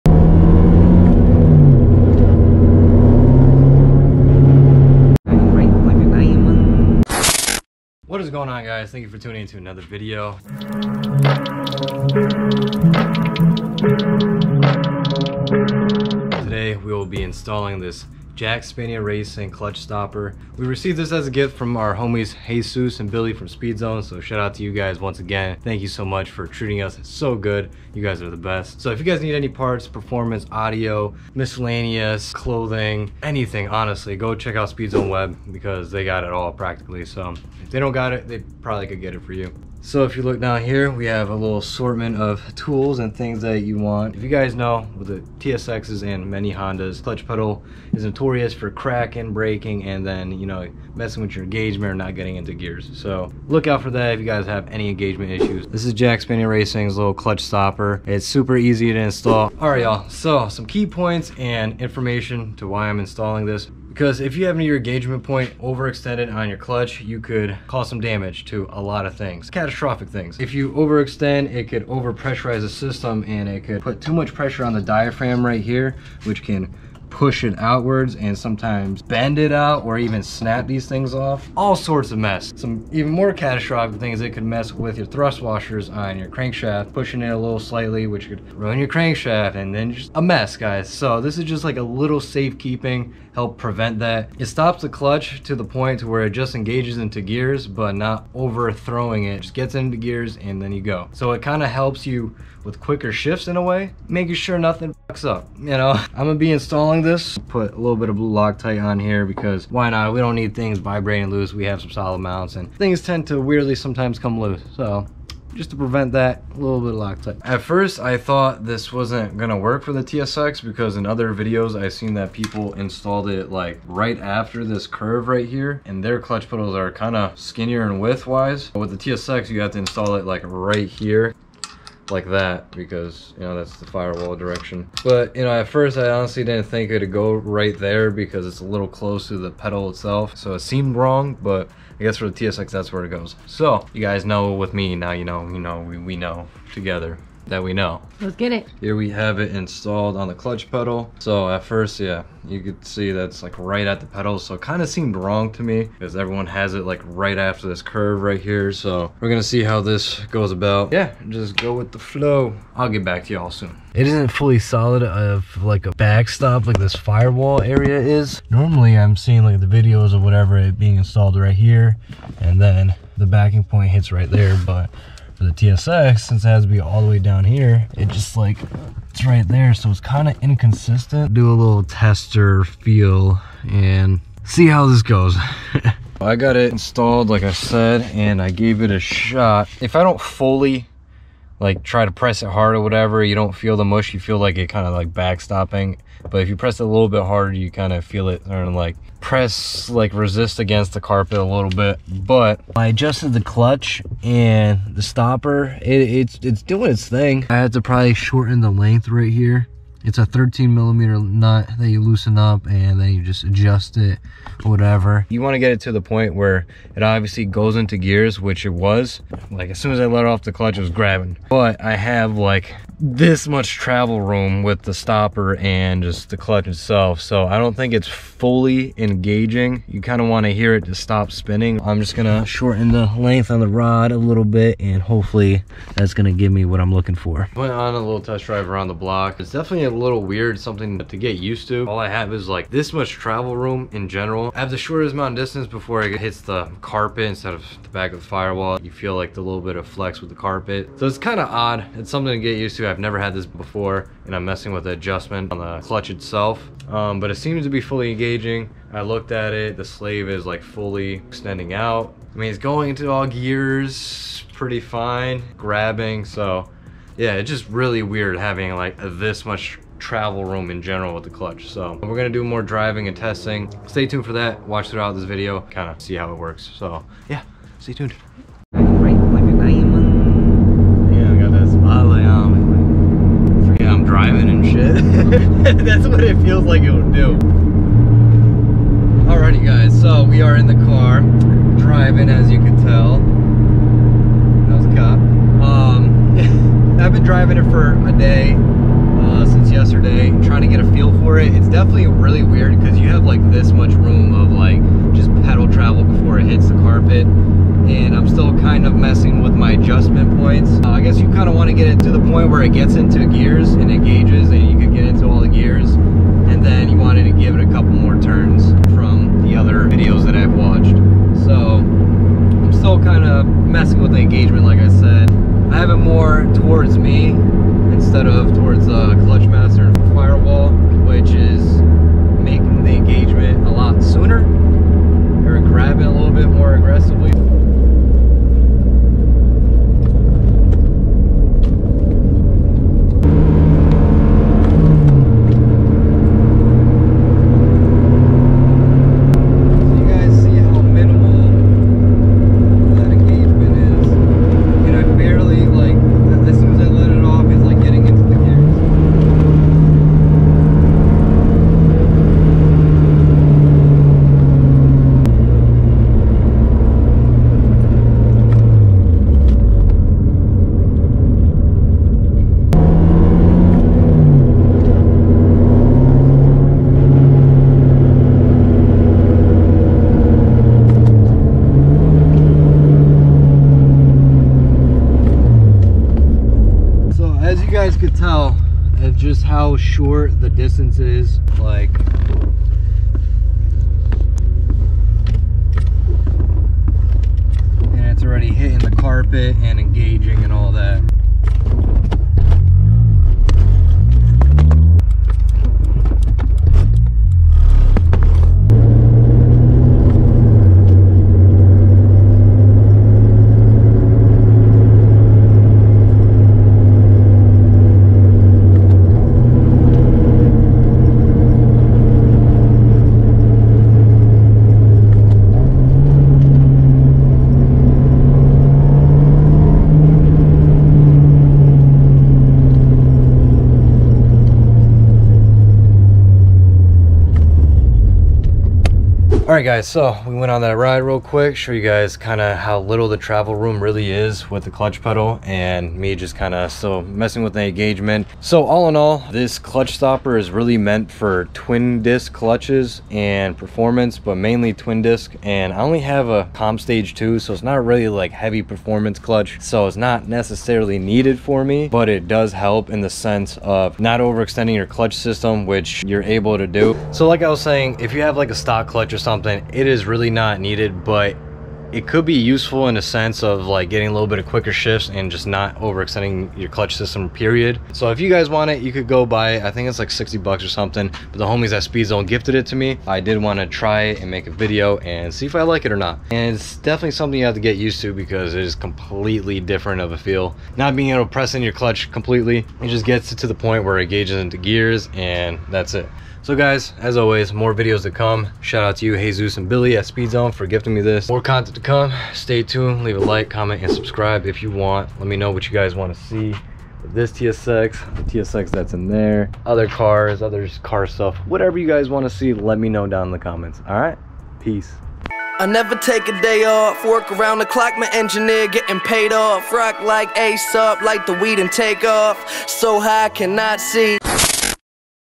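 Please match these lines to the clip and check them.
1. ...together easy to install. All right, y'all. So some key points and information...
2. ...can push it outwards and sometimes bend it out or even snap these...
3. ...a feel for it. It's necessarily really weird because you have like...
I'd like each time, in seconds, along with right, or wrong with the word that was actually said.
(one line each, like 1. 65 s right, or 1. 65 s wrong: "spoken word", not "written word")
1. 58 s wrong: "super", not "together"
2. 76 s right
3. 300 s wrong: "definitely", not "necessarily".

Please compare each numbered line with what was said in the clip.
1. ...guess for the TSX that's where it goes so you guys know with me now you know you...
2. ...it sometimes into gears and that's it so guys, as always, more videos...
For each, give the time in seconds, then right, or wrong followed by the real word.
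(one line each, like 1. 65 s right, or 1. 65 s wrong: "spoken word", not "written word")
1. 142 s right
2. 493 s wrong: "gauges", not "sometimes".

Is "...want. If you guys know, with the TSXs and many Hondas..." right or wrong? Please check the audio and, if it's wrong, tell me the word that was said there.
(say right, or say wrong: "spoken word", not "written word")
right.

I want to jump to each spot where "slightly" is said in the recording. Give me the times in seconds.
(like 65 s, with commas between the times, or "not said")
87 s.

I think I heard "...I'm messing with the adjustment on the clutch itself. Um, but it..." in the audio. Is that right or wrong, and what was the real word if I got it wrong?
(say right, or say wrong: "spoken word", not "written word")
right.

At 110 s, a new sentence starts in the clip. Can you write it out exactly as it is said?
We don't need things vibrating loose.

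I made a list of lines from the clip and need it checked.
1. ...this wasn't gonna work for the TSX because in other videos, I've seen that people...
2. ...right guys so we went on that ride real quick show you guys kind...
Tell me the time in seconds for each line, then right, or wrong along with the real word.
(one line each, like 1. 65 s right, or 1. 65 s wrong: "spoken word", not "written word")
1. 118 s right
2. 439 s right.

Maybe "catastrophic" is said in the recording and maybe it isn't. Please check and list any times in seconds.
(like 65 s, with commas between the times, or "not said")
69 s, 83 s.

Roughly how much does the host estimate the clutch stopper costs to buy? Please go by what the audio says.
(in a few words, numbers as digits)
$60.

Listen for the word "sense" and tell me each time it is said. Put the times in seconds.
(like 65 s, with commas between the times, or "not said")
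463 s, 473 s.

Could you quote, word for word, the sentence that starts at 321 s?
So I'm still kind of messing with the engagement like I said.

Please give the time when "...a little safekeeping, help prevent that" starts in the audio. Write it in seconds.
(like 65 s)
91 s.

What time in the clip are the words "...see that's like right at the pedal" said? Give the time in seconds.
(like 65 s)
152 s.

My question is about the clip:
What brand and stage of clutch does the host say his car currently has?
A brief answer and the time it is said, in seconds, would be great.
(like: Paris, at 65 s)
Comp Stage 2, at 456 s.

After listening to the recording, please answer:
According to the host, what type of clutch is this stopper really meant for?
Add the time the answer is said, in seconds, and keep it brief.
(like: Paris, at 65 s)
Twin disc clutches, at 451 s.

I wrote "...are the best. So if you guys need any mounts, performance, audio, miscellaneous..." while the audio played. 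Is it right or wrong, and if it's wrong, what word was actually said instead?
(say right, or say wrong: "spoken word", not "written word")
wrong: "parts", not "mounts".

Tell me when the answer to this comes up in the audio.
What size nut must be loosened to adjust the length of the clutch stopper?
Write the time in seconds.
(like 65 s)
210 s.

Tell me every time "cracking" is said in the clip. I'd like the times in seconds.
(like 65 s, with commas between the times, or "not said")
48 s.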